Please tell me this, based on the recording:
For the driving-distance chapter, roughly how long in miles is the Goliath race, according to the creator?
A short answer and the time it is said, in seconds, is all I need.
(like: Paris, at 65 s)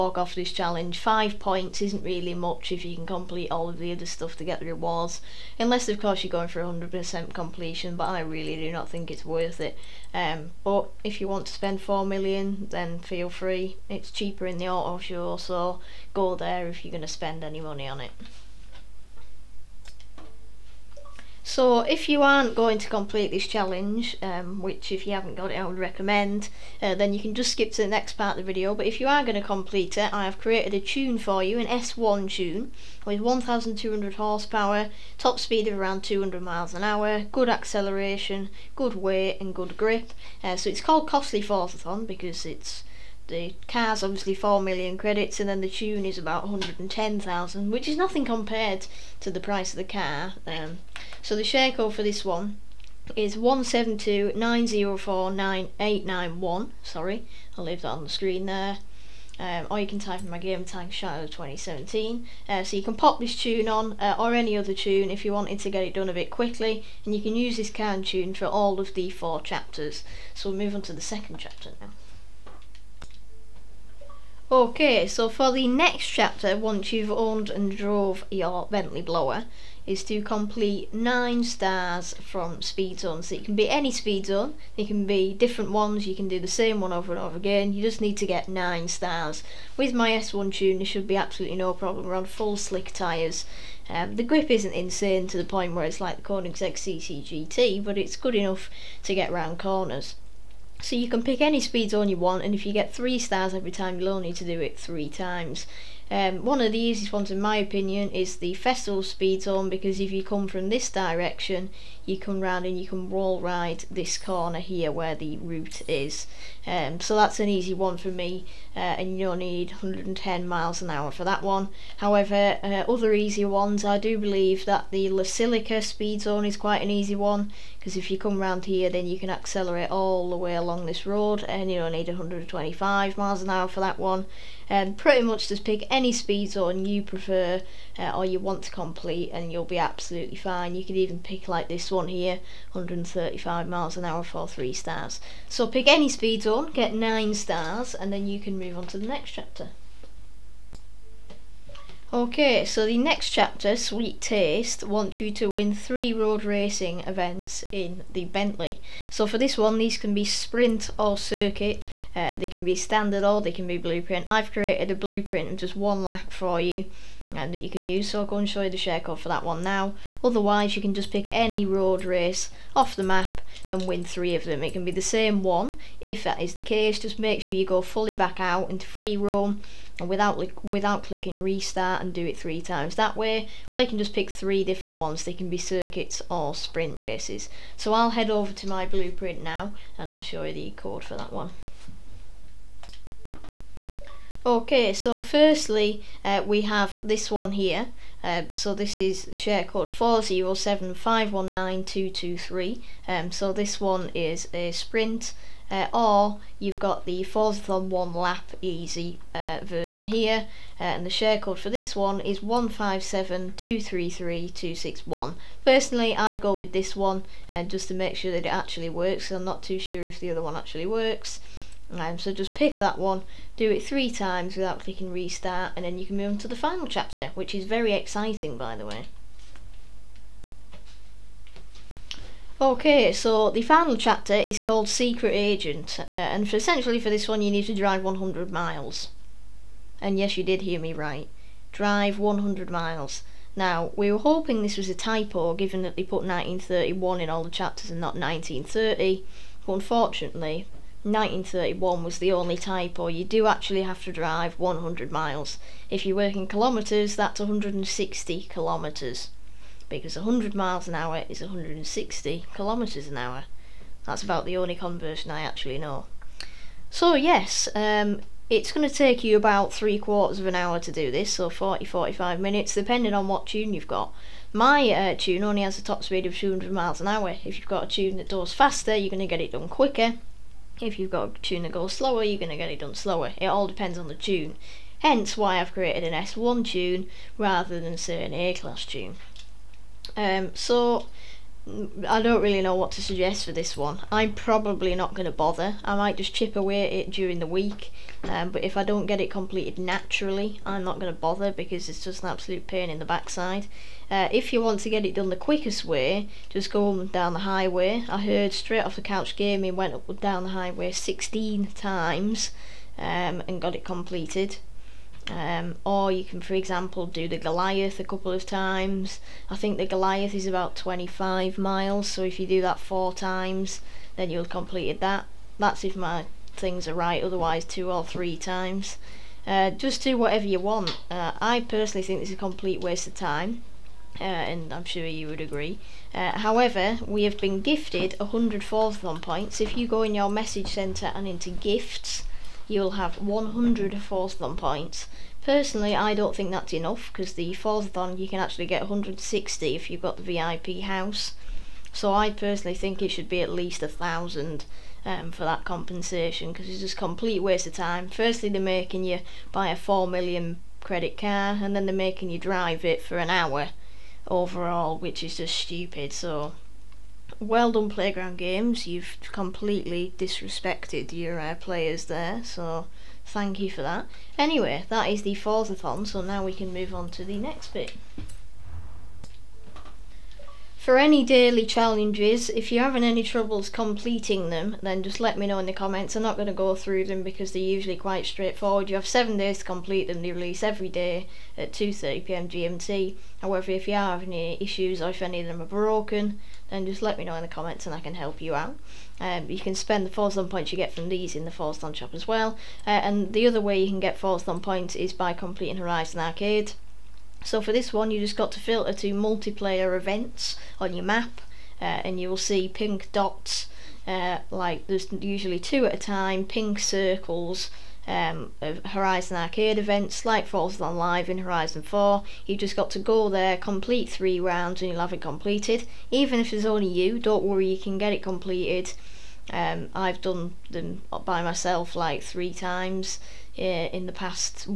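25 miles, at 320 s.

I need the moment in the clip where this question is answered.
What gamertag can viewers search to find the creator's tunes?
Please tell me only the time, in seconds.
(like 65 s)
60 s.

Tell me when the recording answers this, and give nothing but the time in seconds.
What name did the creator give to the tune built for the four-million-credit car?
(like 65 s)
41 s.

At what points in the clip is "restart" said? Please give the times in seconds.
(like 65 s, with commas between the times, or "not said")
181 s, 225 s.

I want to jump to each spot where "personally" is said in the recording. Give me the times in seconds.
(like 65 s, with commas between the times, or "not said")
215 s, 331 s, 345 s, 352 s.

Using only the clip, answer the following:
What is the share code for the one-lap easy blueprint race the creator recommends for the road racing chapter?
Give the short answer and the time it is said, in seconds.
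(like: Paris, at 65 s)
157233261, at 212 s.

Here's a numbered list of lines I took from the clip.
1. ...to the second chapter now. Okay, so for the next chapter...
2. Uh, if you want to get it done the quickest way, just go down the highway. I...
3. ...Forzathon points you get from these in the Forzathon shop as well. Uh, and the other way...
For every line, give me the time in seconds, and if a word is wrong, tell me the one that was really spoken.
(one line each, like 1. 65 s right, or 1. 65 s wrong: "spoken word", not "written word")
1. 70 s right
2. 304 s right
3. 400 s right.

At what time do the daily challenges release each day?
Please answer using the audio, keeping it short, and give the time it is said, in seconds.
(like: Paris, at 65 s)
2:30pm GMT, at 391 s.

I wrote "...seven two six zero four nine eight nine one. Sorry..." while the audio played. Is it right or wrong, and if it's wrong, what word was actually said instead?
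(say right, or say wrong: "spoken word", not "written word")
wrong: "nine", not "six".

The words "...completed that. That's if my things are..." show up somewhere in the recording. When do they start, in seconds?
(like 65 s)
324 s.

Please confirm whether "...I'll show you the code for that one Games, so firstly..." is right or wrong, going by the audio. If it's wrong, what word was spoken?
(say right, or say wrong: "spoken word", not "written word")
wrong: "Okay", not "Games".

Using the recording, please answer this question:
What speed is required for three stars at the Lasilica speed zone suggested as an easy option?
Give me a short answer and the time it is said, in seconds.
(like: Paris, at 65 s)
125 mph, at 132 s.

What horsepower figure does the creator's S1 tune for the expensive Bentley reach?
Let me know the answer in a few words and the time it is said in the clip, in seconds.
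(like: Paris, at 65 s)
1200, at 33 s.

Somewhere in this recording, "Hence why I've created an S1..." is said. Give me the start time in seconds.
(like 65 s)
284 s.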